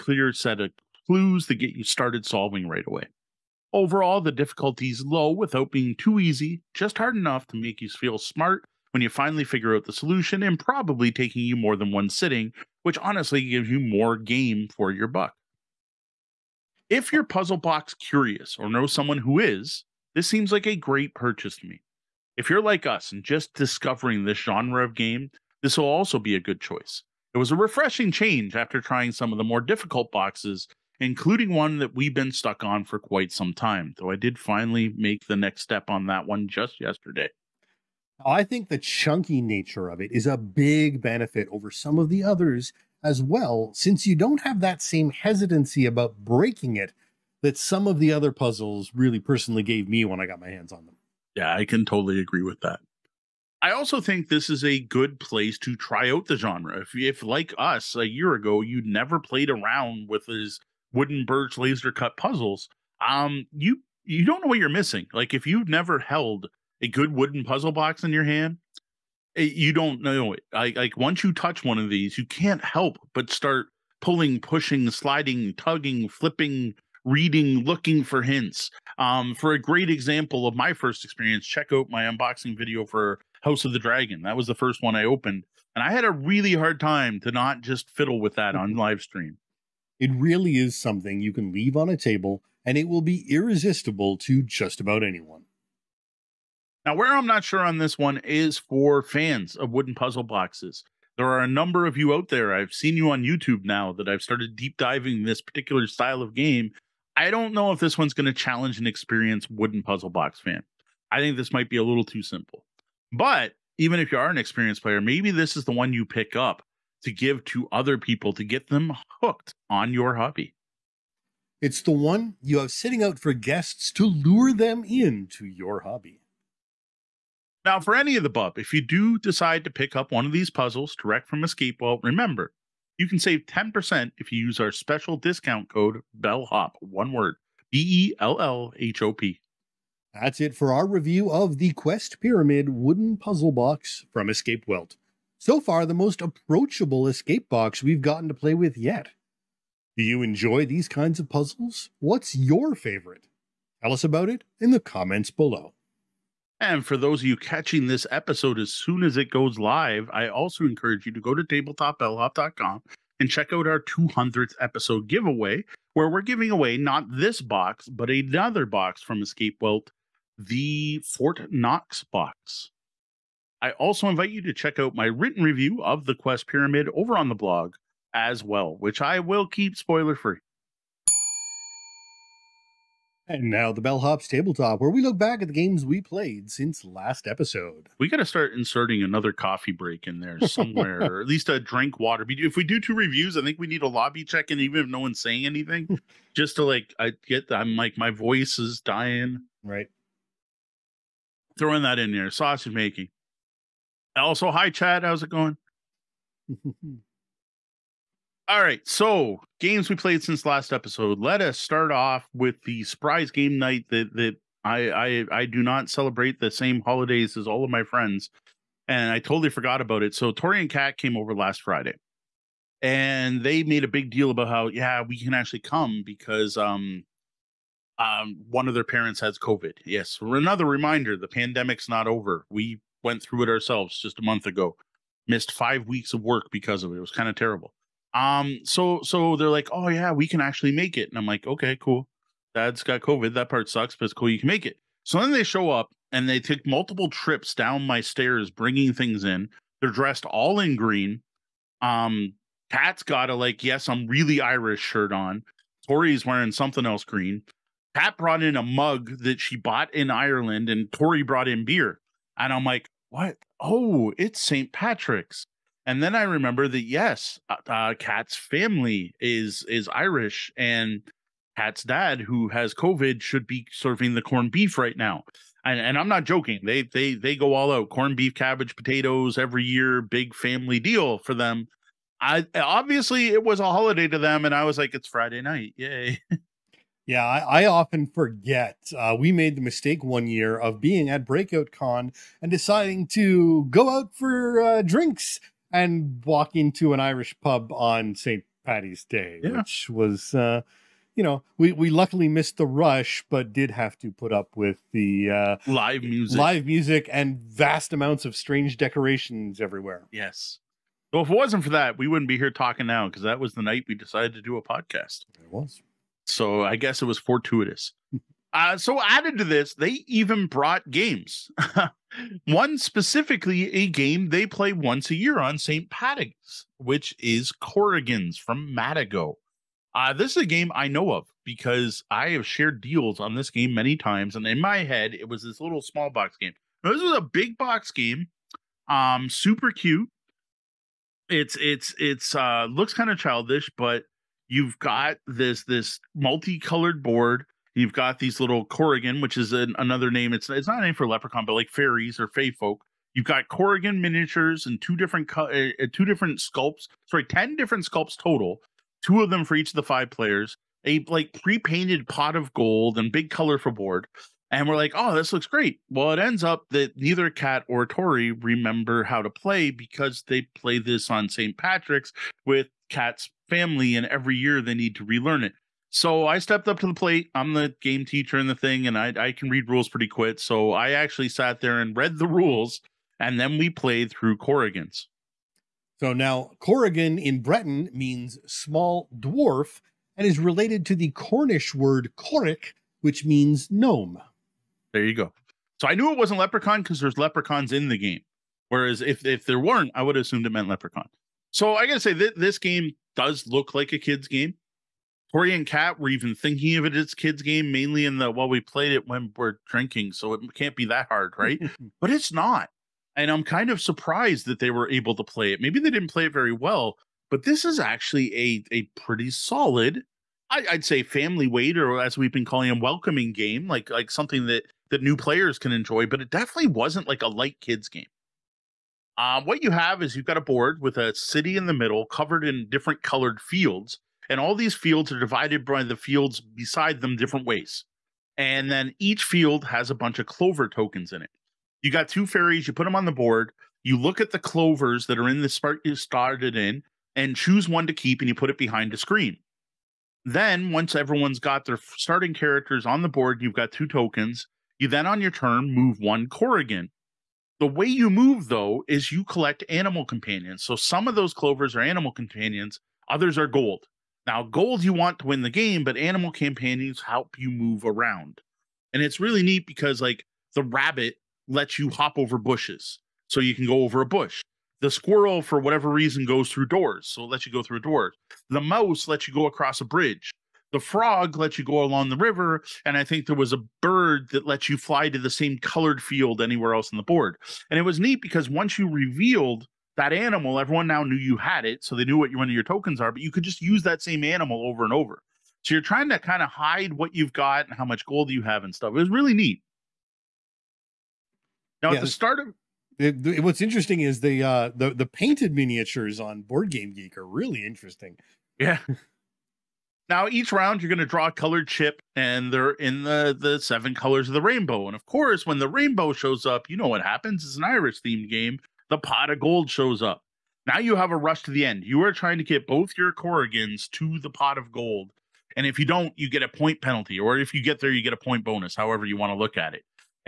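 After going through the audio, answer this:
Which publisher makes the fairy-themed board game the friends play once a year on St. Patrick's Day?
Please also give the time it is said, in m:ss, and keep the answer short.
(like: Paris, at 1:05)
Matagot, at 5:28.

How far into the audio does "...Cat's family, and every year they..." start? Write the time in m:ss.
6:12.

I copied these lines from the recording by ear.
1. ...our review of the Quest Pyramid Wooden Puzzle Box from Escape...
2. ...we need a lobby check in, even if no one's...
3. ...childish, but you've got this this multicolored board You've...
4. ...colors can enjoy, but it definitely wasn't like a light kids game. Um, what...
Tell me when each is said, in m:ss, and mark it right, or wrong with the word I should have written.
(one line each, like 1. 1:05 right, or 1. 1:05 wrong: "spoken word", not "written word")
1. 2:20 right
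2. 3:13 right
3. 5:43 right
4. 7:05 wrong: "players", not "colors".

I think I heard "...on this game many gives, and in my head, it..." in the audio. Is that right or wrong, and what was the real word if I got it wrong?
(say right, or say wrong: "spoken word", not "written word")
wrong: "times", not "gives".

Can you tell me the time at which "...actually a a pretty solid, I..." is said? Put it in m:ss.
6:57.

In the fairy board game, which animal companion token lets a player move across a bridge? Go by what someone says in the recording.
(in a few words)
mouse.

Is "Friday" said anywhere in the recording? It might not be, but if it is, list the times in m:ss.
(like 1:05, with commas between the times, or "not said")
3:41, 4:45.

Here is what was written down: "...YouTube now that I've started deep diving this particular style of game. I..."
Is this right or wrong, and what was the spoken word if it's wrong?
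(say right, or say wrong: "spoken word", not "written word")
right.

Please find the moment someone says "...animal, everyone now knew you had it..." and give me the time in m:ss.
8:10.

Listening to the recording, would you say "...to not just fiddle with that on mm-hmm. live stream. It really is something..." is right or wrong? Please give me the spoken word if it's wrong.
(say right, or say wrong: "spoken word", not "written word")
right.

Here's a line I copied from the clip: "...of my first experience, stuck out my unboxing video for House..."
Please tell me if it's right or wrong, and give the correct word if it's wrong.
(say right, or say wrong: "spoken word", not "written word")
wrong: "check", not "stuck".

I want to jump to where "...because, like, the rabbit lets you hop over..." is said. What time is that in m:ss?
7:49.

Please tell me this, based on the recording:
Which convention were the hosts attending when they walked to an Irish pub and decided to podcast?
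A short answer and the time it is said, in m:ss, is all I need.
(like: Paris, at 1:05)
Breakout Con, at 4:51.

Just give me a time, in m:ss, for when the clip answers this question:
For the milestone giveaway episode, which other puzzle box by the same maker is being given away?
2:50.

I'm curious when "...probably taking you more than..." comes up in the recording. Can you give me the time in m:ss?
0:10.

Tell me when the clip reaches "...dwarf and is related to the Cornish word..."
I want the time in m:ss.
6:29.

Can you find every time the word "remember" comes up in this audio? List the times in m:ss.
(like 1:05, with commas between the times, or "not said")
2:12, 4:26, 6:08.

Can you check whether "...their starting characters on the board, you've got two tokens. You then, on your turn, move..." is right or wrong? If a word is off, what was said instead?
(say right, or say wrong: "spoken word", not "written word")
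right.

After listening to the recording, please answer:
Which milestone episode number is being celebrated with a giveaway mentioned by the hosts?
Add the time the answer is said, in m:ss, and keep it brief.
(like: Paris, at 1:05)
200th, at 2:43.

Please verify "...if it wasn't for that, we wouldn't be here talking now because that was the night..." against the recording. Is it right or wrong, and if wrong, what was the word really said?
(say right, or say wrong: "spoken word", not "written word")
right.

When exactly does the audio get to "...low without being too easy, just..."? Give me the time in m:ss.
0:05.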